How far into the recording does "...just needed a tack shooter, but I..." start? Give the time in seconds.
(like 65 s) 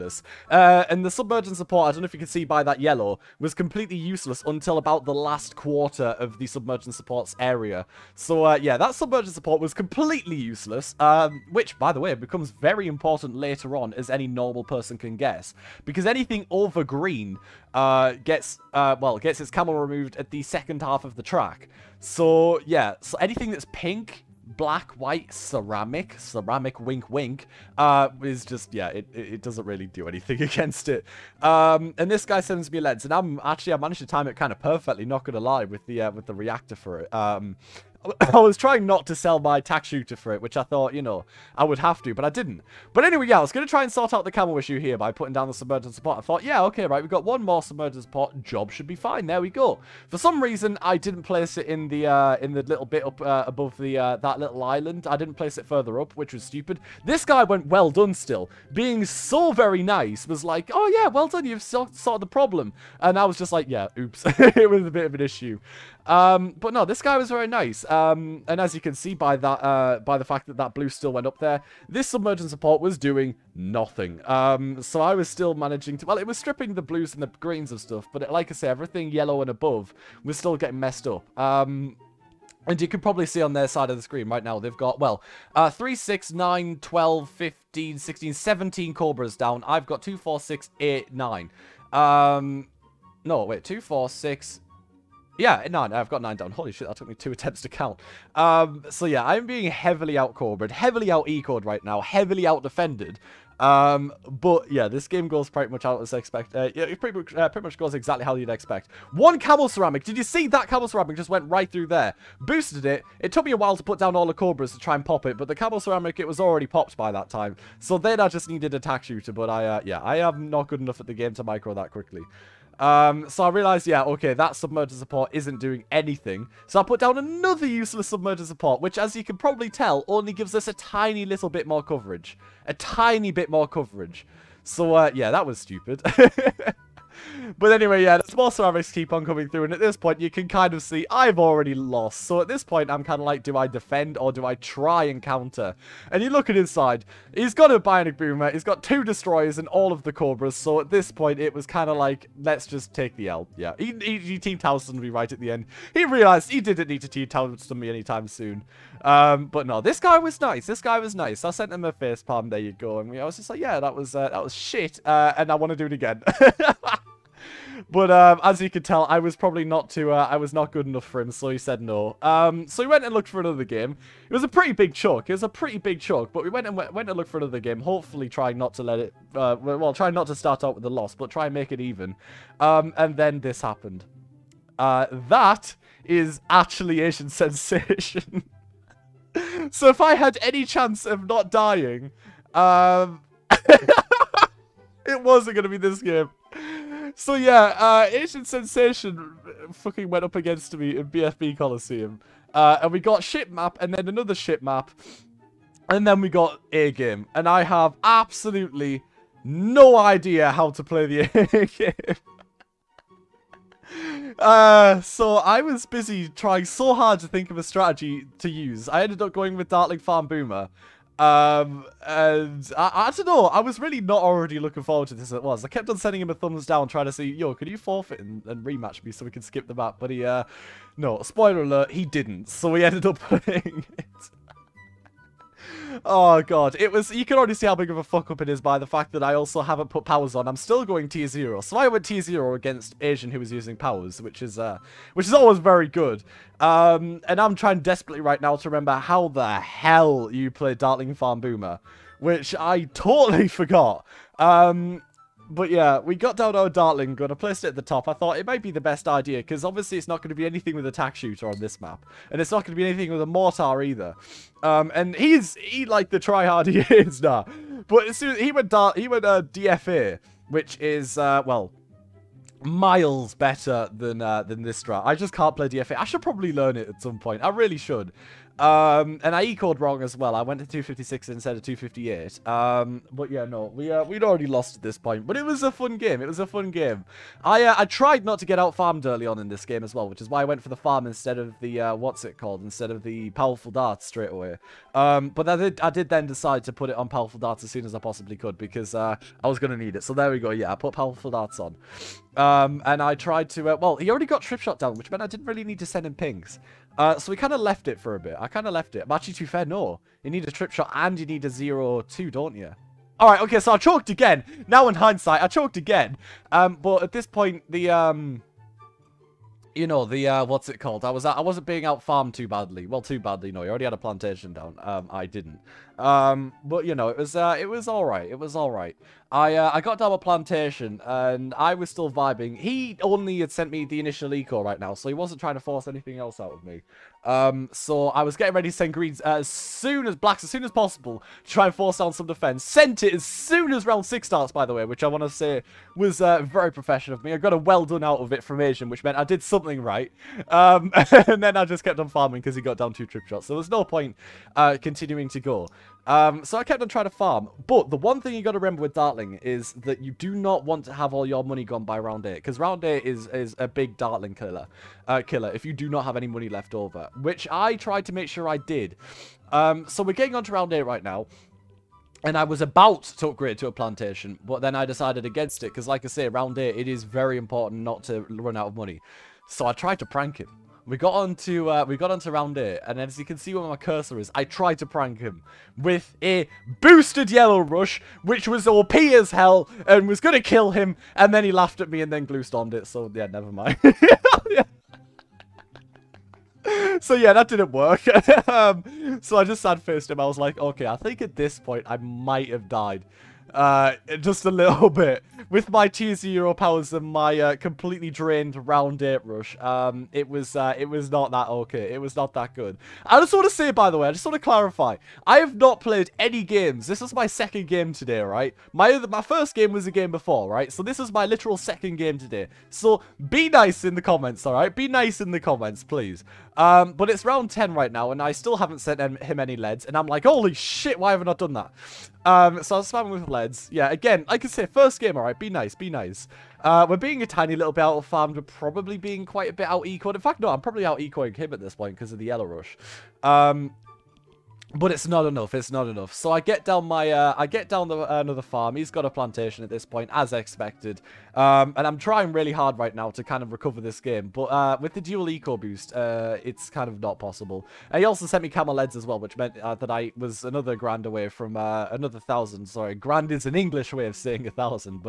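118 s.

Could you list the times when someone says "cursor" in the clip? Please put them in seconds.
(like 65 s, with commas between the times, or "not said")
383 s.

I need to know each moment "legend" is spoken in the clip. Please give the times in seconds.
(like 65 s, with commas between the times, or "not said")
not said.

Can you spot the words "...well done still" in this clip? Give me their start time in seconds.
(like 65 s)
57 s.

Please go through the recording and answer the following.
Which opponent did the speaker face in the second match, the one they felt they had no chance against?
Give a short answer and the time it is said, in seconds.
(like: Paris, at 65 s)
Asian Sensation, at 186 s.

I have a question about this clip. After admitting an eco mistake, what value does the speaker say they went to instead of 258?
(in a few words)
256.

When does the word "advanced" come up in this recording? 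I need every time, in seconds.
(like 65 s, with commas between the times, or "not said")
not said.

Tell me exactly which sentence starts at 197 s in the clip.
So yeah, uh, Asian Sensation fucking went up against me in BFB Coliseum.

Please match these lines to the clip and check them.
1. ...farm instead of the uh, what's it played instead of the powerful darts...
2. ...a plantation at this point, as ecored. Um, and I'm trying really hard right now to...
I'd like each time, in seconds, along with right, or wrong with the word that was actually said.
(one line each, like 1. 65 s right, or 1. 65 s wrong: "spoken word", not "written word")
1. 290 s wrong: "called", not "played"
2. 449 s wrong: "expected", not "ecored".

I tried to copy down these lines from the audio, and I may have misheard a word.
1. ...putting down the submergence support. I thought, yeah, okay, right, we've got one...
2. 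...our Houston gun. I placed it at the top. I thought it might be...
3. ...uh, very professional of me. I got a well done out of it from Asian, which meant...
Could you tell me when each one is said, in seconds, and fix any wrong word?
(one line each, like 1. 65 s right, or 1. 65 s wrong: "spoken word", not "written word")
1. 45 s right
2. 256 s wrong: "Dartling", not "Houston"
3. 346 s right.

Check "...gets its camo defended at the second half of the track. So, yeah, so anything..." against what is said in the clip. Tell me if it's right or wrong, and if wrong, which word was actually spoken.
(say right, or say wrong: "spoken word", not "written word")
wrong: "removed", not "defended".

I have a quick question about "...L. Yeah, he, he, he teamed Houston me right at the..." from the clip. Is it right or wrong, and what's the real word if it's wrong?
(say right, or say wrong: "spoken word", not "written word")
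right.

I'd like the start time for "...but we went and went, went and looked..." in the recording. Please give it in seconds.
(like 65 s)
176 s.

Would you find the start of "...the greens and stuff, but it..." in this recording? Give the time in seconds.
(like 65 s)
77 s.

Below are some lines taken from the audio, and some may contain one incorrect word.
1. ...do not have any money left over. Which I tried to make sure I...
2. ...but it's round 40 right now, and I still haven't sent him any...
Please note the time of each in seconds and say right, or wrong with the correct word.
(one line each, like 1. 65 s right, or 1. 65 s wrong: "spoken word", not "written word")
1. 365 s right
2. 426 s wrong: "10", not "40".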